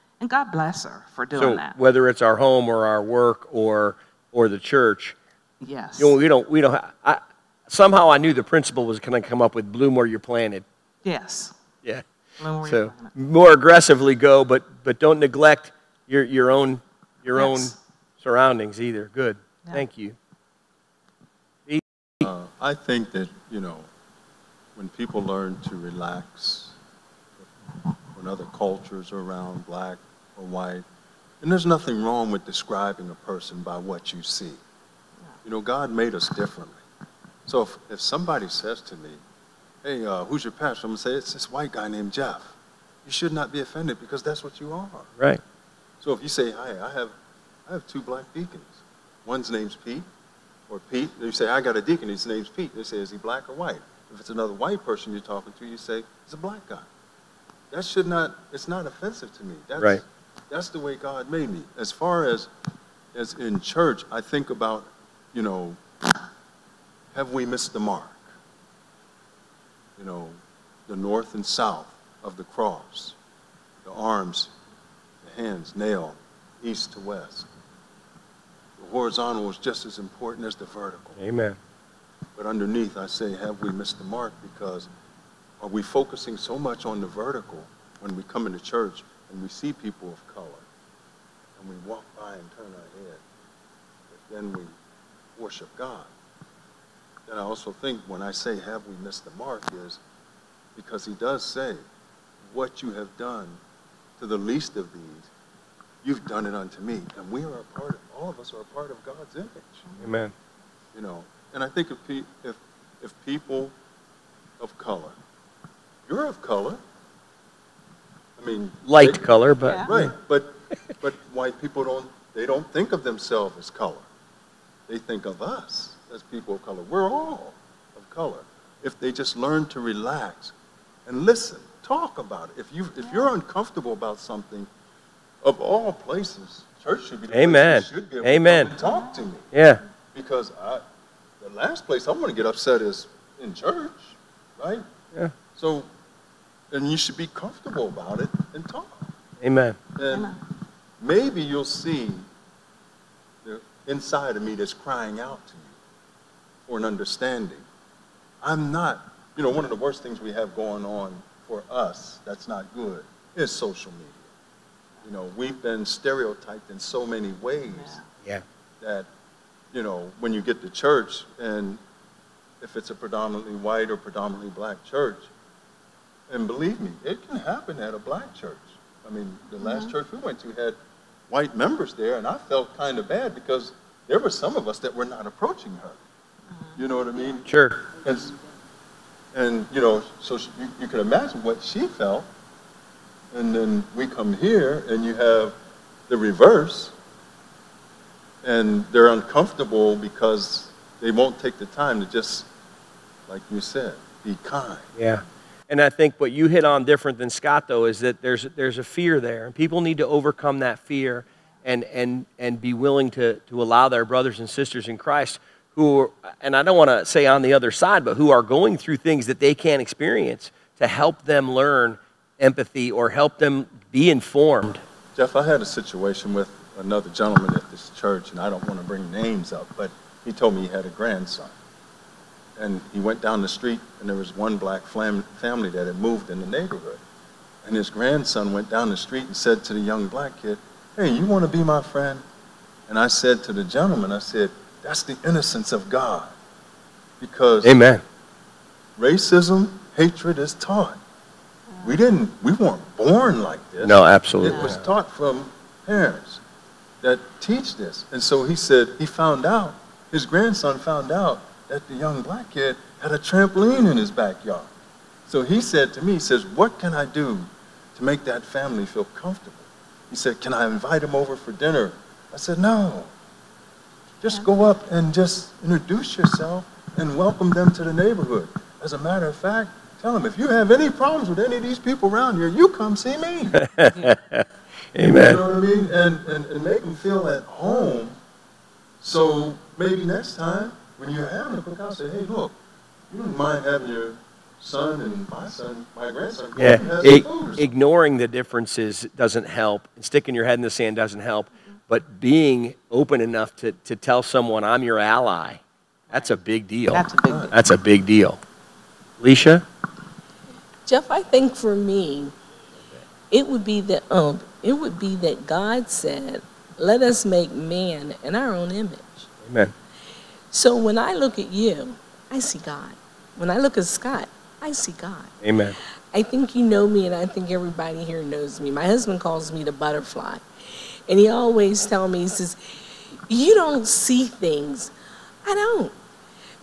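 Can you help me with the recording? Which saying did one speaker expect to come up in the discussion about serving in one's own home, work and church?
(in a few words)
Bloom where you're planted.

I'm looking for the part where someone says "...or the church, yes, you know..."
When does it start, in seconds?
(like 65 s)
4 s.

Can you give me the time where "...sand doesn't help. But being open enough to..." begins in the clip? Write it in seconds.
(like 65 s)
300 s.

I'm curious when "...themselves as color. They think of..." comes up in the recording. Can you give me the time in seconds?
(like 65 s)
123 s.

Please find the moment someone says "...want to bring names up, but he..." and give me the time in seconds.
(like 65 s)
228 s.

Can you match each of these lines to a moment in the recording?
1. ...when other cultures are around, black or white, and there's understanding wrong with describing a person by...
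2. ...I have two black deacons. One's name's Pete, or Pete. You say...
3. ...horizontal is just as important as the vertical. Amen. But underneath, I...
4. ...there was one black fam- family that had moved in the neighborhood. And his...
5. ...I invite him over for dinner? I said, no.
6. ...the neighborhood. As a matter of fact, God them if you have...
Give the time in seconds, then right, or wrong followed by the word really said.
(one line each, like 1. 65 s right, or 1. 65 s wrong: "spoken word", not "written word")
1. 28 s wrong: "nothing", not "understanding"
2. 47 s right
3. 78 s right
4. 234 s right
5. 270 s right
6. 277 s wrong: "Tell", not "God".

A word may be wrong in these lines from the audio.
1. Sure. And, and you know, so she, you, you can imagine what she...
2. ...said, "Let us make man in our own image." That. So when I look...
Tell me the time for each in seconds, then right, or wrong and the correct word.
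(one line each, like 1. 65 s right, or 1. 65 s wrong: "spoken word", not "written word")
1. 187 s right
2. 315 s wrong: "Amen", not "That".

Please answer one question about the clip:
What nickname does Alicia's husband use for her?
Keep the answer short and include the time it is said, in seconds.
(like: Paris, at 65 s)
The butterfly, at 329 s.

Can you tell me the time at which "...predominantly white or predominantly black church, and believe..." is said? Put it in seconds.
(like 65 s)
172 s.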